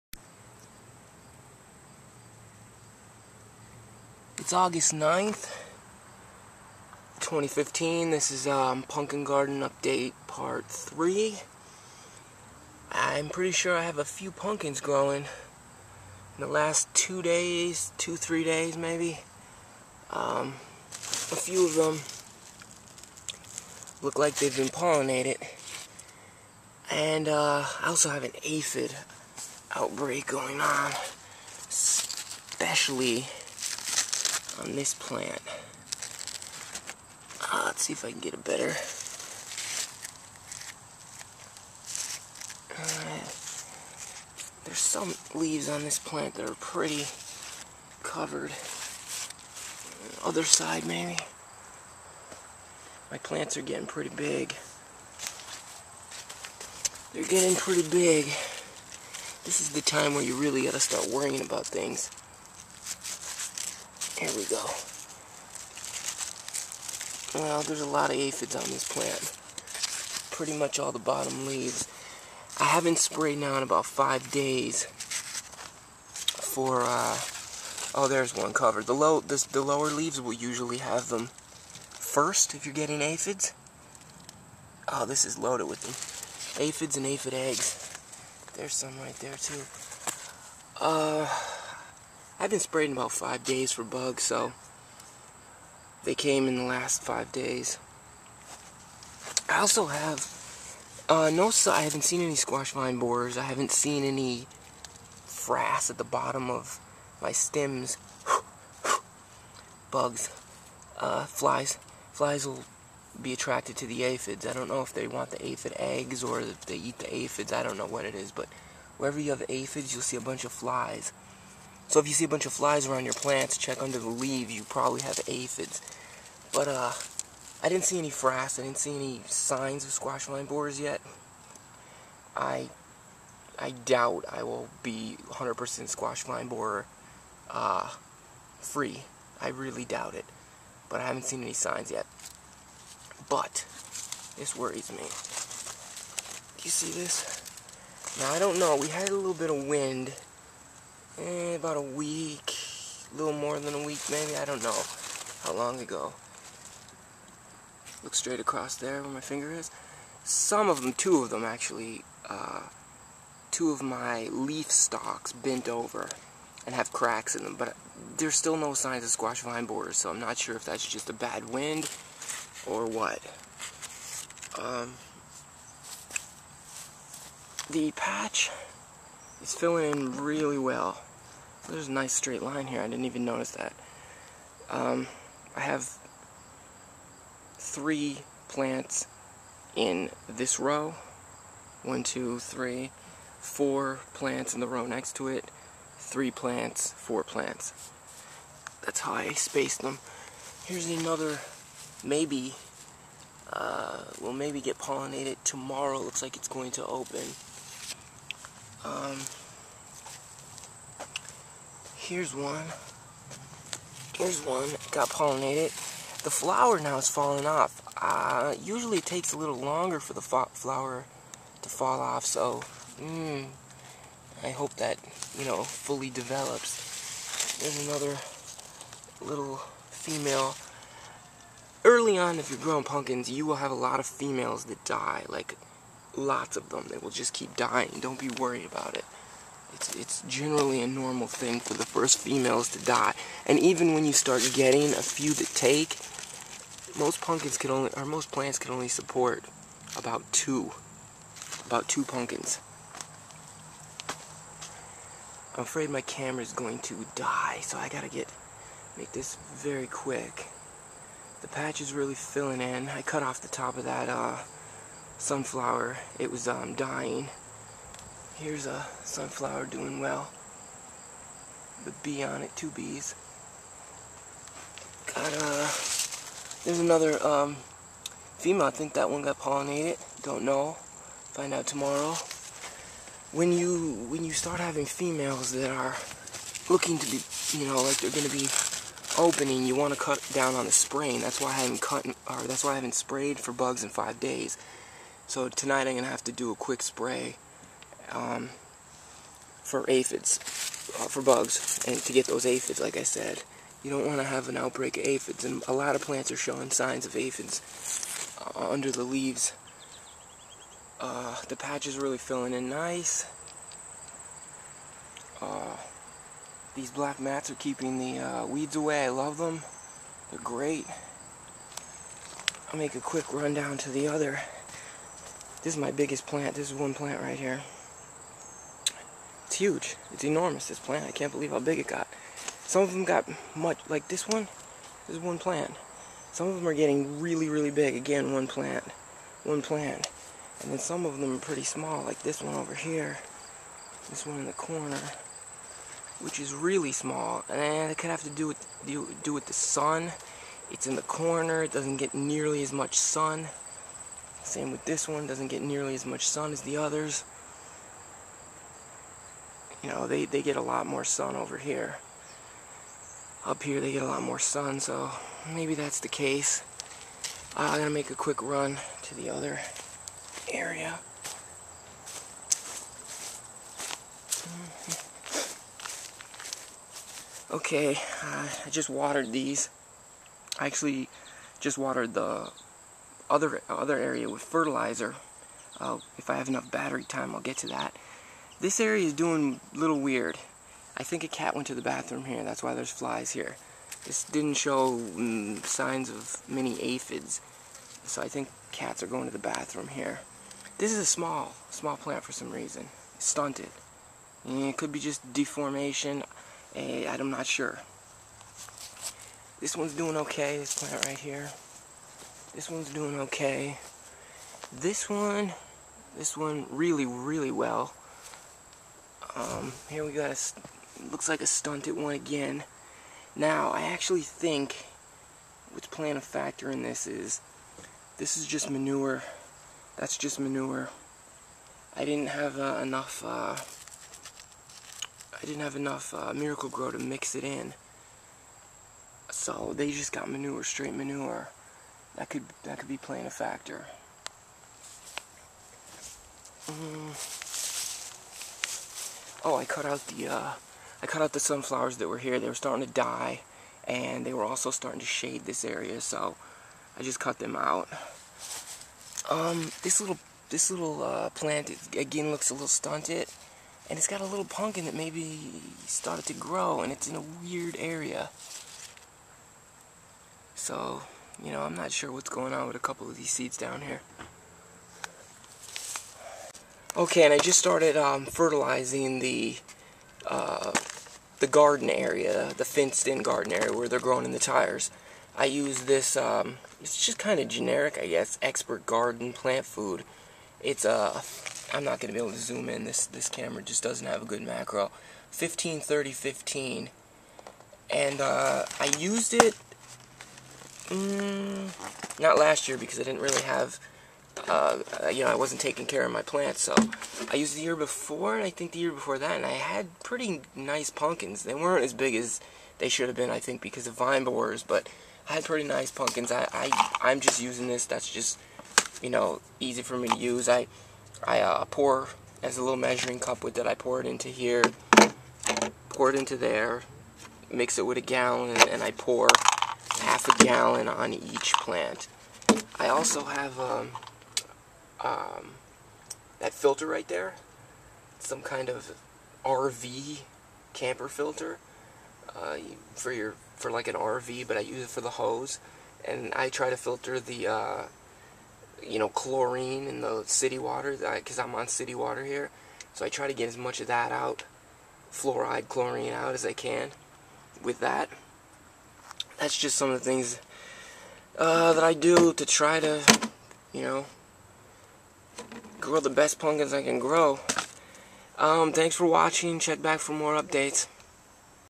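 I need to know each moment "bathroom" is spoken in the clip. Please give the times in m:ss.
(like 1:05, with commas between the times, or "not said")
6:31, 6:39.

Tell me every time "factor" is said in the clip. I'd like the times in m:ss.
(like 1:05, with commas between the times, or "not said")
7:06, 7:23.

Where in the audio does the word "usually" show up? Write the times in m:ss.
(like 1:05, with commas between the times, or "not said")
1:20, 3:38.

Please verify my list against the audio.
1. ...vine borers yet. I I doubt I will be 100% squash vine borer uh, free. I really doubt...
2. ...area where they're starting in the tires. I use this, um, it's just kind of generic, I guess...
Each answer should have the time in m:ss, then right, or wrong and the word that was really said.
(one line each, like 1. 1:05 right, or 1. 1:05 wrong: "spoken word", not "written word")
1. 2:10 right
2. 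8:03 wrong: "growing", not "starting".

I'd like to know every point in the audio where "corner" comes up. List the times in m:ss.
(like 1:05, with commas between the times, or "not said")
5:44, 5:51.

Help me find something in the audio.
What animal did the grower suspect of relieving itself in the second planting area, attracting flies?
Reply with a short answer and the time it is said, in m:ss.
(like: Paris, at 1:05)
cat, at 6:31.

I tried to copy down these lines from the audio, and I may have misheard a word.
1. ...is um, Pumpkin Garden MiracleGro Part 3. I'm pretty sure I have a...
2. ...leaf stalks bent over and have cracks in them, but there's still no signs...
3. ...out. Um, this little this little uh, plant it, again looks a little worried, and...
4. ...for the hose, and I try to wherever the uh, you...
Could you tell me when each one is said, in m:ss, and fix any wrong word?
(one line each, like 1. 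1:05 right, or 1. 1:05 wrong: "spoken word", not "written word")
1. 0:08 wrong: "Update", not "MiracleGro"
2. 2:44 right
3. 7:37 wrong: "stunted", not "worried"
4. 9:04 wrong: "filter", not "wherever".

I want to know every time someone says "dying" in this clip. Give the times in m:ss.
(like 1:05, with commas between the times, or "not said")
3:57, 4:26.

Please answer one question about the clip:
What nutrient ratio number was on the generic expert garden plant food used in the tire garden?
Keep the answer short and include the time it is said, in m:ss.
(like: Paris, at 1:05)
153015, at 8:15.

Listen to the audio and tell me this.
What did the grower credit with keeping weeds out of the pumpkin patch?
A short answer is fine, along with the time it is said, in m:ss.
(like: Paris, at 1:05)
black mats, at 5:16.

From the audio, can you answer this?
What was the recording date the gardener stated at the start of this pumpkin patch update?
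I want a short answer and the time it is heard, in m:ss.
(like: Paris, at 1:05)
August 9th, 2015, at 0:04.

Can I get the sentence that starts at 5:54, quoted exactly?
Same with this one, doesn't get nearly as much sun as the others.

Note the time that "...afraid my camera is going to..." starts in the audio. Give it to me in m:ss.
4:15.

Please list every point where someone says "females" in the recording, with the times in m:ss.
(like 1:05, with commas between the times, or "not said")
3:49, 3:54, 4:02, 4:38, 4:44.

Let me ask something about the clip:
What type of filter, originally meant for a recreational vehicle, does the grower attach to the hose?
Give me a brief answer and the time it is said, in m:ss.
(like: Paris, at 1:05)
RV camper filter, at 8:59.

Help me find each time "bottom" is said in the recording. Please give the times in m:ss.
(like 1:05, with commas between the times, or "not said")
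1:10, 1:46.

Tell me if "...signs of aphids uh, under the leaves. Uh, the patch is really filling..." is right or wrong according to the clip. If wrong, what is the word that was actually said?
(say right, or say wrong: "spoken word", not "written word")
right.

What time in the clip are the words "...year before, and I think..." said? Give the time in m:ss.
8:27.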